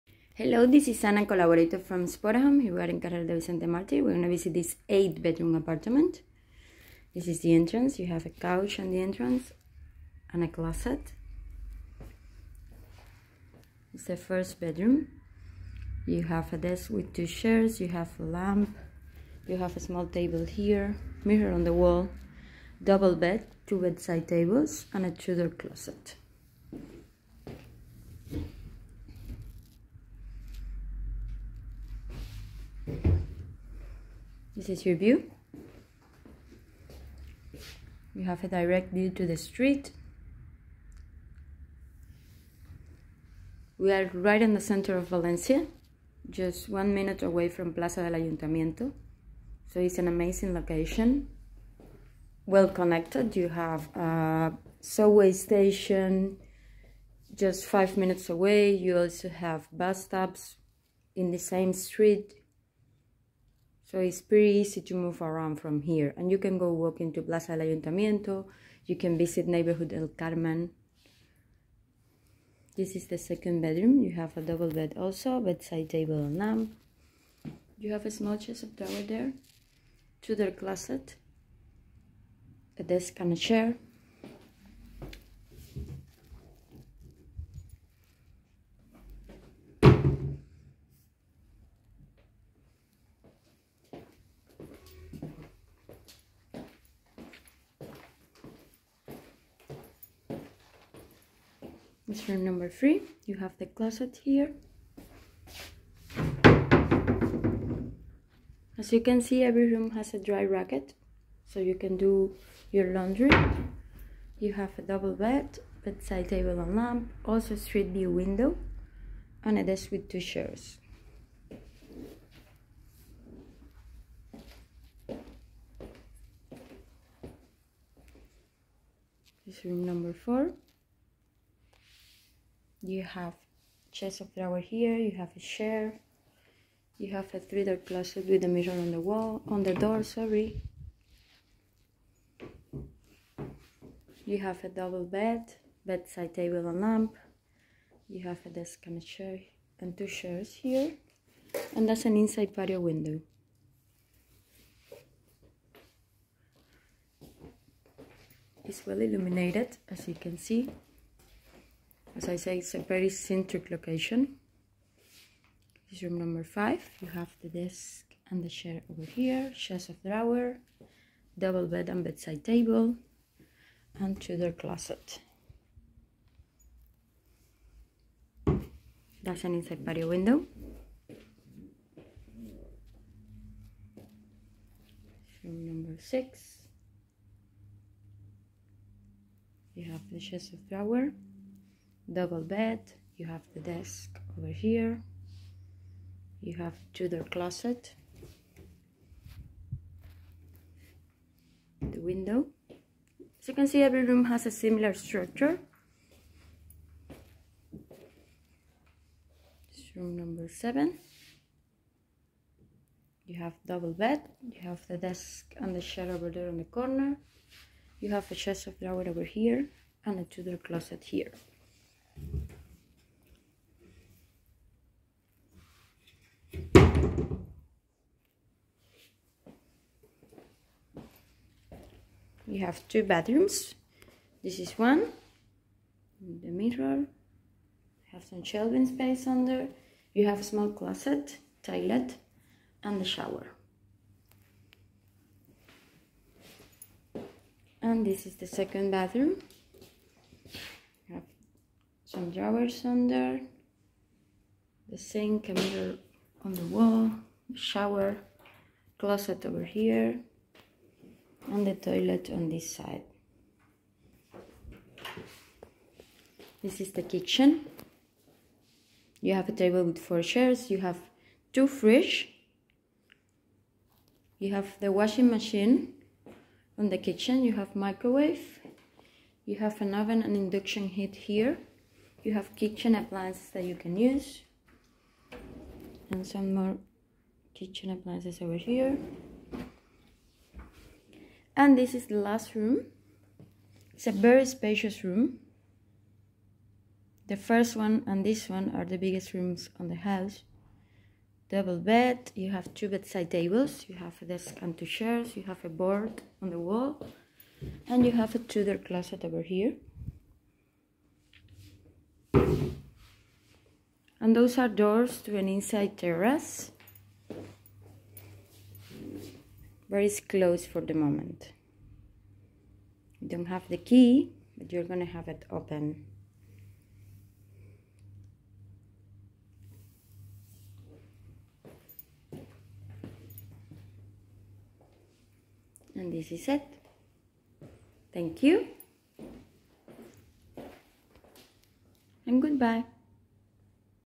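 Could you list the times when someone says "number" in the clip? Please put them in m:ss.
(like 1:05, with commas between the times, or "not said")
1:42, 2:09, 2:46, 3:05, 3:30.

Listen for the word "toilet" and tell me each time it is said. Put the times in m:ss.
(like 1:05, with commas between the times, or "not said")
4:01, 4:21.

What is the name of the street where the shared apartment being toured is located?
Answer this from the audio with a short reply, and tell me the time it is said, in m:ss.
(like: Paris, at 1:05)
Carrer de Vicente Martí, at 0:02.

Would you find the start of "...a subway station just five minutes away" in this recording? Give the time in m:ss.
0:53.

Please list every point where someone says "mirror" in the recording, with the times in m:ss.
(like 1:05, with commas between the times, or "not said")
0:21, 2:18, 3:56, 4:15.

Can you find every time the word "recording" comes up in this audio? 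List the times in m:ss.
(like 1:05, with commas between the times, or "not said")
not said.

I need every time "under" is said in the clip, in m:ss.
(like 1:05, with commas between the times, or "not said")
3:59, 4:12.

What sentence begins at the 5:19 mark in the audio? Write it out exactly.
But it's closed for the moment.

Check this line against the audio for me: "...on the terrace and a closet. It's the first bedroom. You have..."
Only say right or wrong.
wrong.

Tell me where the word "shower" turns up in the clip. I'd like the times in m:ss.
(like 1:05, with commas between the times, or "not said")
4:03, 4:17.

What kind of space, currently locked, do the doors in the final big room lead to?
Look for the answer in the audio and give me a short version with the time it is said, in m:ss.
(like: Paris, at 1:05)
Inside terrace, at 5:15.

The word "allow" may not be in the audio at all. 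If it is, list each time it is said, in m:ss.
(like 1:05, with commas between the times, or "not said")
not said.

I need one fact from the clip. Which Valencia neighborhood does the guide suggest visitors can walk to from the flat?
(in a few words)
El Carmen.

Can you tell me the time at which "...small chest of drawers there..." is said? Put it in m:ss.
1:18.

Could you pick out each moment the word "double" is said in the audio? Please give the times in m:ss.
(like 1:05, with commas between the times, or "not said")
0:22, 1:14, 1:54, 2:24, 2:51, 3:12, 3:33, 5:01.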